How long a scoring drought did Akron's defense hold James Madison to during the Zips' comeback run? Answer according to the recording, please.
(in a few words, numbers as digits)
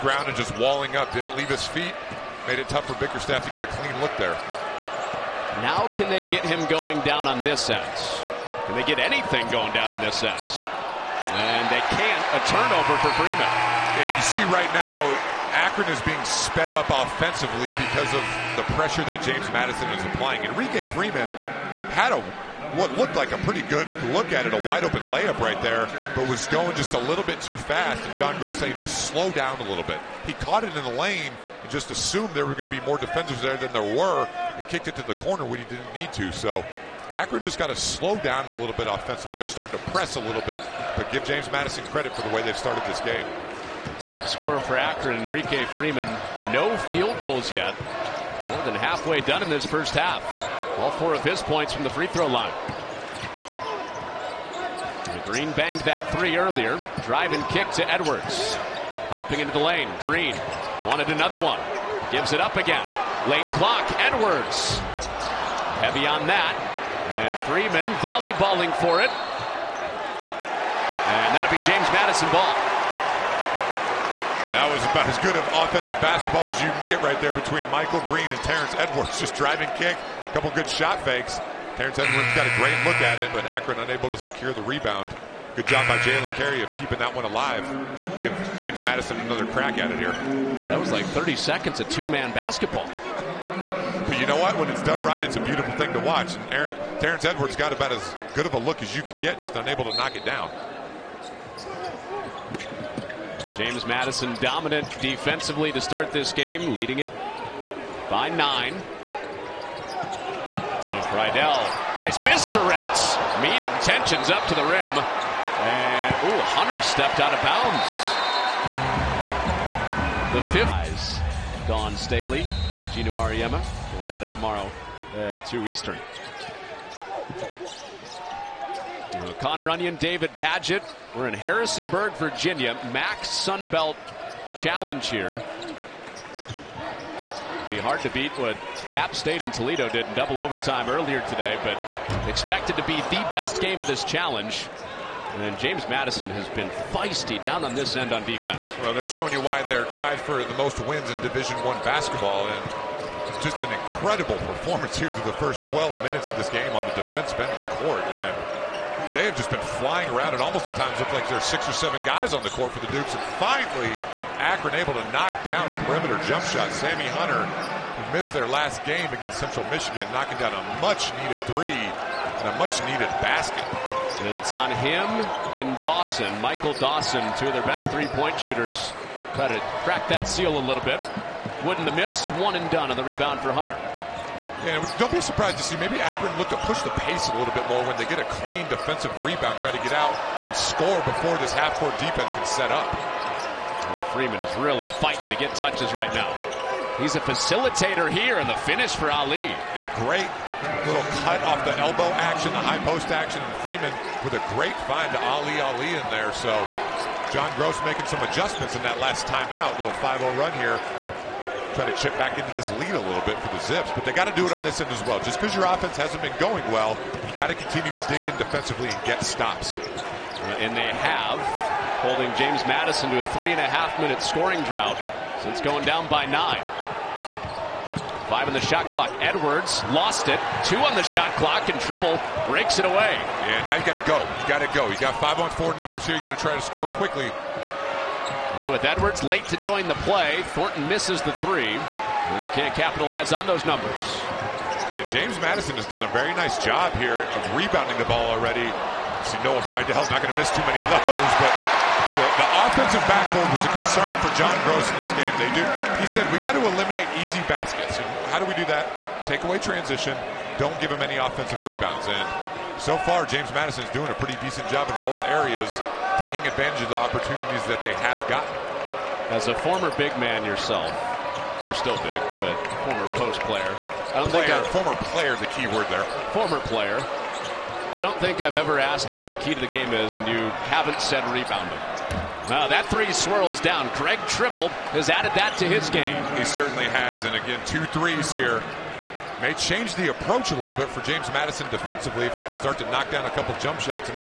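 3.5 minutes.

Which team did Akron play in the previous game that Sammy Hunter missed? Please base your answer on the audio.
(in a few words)
Central Michigan.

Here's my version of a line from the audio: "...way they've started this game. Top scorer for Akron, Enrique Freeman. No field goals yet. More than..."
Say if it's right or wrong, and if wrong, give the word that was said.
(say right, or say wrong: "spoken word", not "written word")
right.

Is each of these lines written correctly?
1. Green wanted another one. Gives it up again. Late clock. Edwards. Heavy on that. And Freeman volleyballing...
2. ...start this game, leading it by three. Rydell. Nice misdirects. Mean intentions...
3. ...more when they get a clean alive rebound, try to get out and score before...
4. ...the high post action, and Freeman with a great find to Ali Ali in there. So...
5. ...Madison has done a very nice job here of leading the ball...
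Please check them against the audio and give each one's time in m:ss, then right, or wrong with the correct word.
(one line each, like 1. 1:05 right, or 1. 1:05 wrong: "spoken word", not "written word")
1. 0:59 right
2. 1:45 wrong: "nine", not "three"
3. 3:07 wrong: "defensive", not "alive"
4. 3:22 right
5. 4:05 wrong: "rebounding", not "leading".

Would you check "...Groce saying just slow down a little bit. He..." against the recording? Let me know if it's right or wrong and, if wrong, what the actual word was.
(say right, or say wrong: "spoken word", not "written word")
right.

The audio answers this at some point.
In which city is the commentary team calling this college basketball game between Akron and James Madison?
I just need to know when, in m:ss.
2:11.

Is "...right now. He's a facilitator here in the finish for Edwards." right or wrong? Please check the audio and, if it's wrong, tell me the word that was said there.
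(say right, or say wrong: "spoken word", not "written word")
wrong: "Ali", not "Edwards".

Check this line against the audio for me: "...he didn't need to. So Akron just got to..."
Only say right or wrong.
right.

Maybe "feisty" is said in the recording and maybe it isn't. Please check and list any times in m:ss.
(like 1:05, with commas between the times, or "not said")
2:26.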